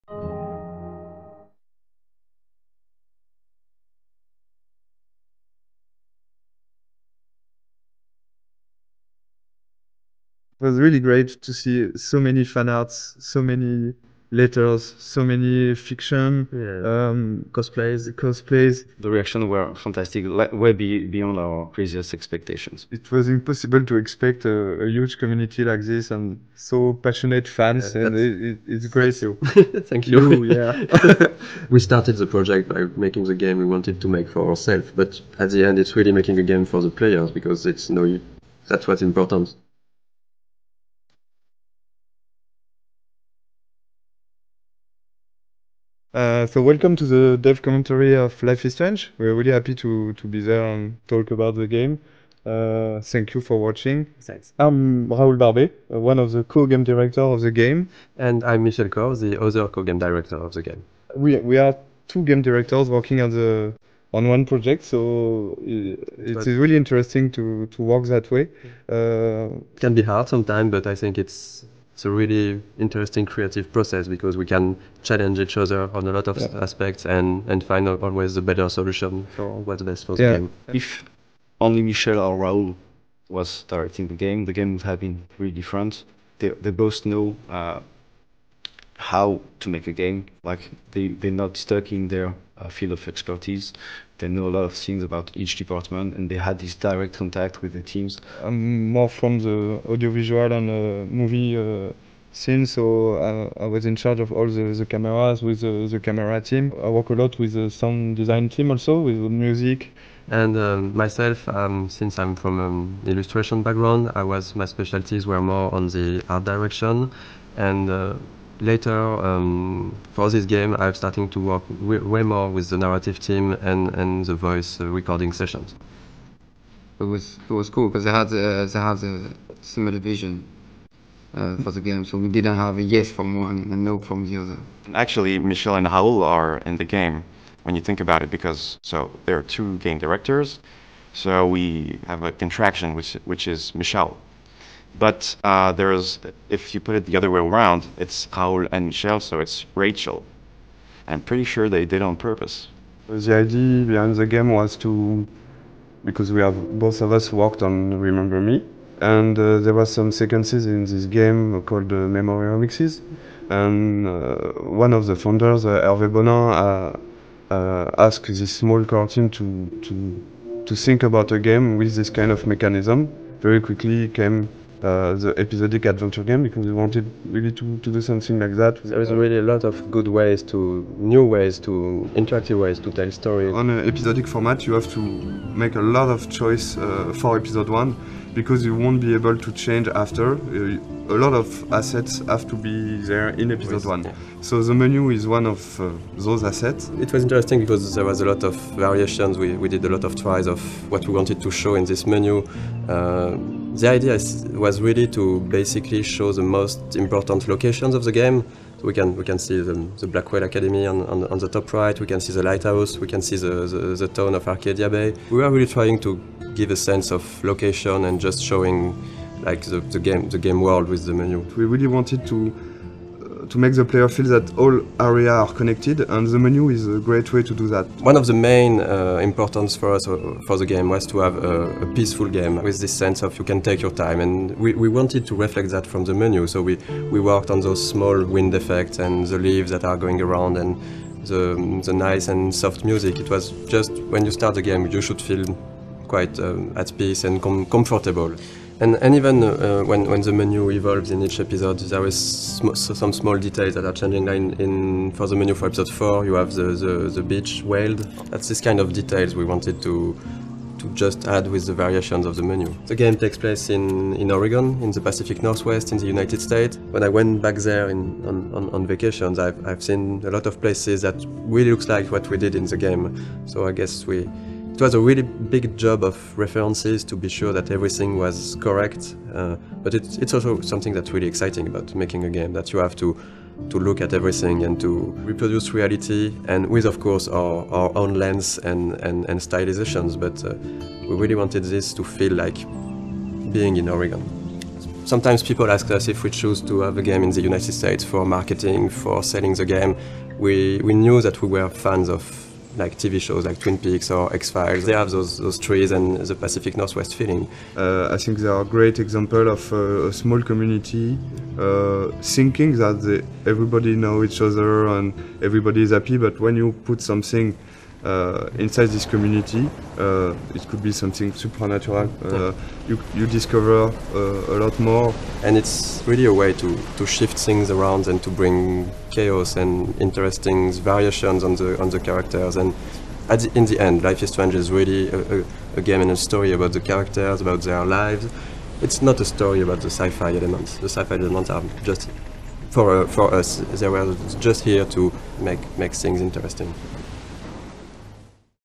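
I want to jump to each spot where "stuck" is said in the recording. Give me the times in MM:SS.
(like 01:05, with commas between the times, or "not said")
01:31.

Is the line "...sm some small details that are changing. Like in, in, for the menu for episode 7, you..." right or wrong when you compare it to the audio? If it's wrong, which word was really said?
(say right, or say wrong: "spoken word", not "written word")
wrong: "4", not "7".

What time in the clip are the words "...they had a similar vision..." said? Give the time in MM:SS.
02:08.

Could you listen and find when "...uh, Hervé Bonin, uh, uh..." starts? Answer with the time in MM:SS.
02:45.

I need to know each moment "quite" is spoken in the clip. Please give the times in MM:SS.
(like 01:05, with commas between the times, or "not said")
04:06.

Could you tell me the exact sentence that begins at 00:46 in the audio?
Uh, so welcome to the dev commentary of Life is Strange.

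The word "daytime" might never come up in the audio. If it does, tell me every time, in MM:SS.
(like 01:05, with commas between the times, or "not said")
not said.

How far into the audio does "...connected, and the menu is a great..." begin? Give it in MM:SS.
03:45.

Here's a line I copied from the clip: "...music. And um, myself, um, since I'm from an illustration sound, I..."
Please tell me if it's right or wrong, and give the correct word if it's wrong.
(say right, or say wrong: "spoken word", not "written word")
wrong: "background", not "sound".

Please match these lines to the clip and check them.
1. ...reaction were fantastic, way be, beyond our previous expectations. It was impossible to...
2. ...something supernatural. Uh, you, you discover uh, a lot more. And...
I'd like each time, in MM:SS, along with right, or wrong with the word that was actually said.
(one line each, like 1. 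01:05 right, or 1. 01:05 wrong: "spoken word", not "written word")
1. 00:19 right
2. 05:20 right.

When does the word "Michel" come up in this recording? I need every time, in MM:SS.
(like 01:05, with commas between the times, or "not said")
00:58, 01:21, 02:15, 02:23, 02:28.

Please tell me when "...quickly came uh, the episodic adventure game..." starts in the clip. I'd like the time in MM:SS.
02:53.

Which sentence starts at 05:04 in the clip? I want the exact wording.
They have those, those trees and the Pacific Northwest feeling.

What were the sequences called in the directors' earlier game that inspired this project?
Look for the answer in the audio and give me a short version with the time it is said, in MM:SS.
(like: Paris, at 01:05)
Memory Mixes, at 02:42.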